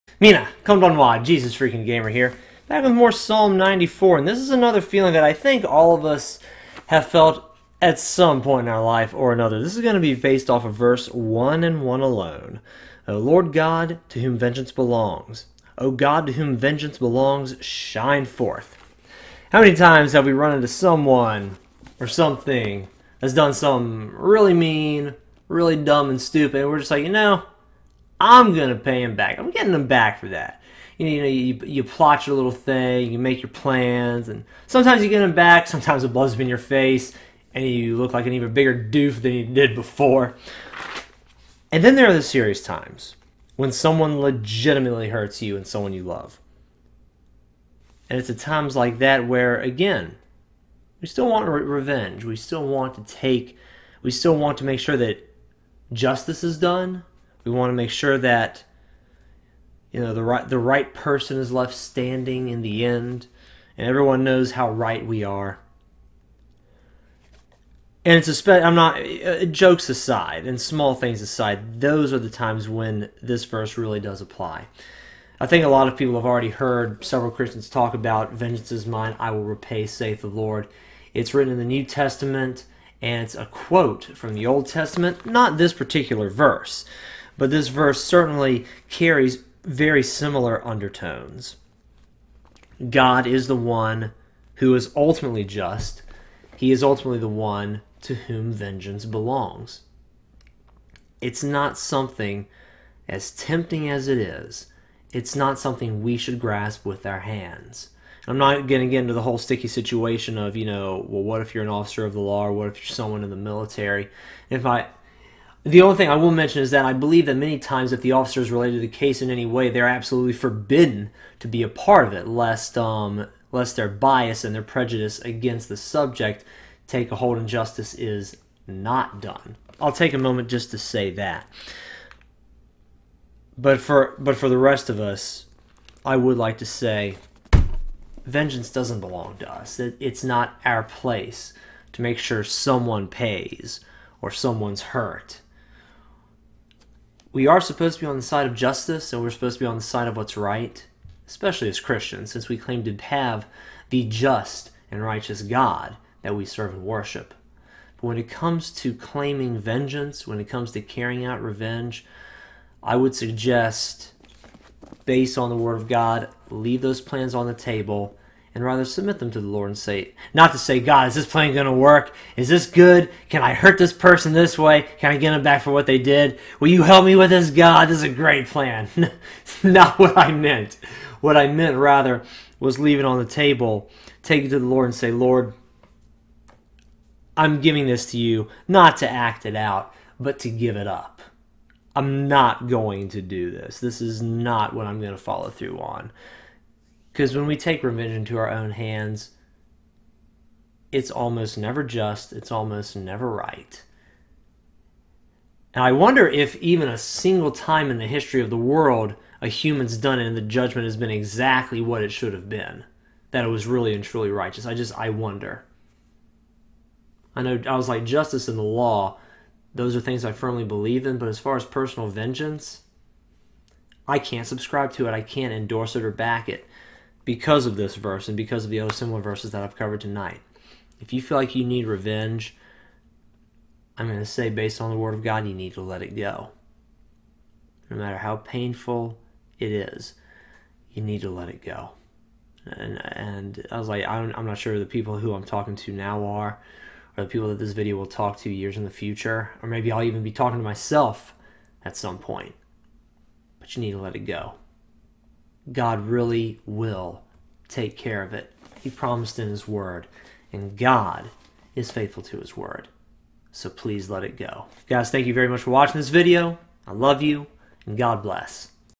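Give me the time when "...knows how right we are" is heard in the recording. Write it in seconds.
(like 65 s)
64 s.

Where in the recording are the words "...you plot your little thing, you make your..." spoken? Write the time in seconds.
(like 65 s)
31 s.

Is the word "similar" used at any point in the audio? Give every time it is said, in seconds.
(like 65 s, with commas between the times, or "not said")
90 s, 228 s.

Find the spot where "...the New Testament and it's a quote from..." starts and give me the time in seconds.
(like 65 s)
81 s.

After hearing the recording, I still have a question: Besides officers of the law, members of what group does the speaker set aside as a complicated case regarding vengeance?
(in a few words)
The military.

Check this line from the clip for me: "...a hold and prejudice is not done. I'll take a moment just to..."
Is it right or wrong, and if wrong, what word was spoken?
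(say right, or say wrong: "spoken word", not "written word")
wrong: "justice", not "prejudice".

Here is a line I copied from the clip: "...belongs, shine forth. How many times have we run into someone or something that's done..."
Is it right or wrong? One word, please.
right.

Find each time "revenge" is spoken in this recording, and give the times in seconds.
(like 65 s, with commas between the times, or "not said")
51 s, 161 s, 197 s, 231 s.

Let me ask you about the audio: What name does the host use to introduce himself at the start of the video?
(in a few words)
Jesus Freakin Gamer.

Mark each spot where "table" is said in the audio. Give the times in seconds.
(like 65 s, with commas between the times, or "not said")
167 s, 183 s.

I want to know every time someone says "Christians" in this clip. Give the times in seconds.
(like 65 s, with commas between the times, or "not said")
77 s, 151 s.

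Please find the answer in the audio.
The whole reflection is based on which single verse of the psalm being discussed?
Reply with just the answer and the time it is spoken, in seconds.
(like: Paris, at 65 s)
Verse 1, at 10 s.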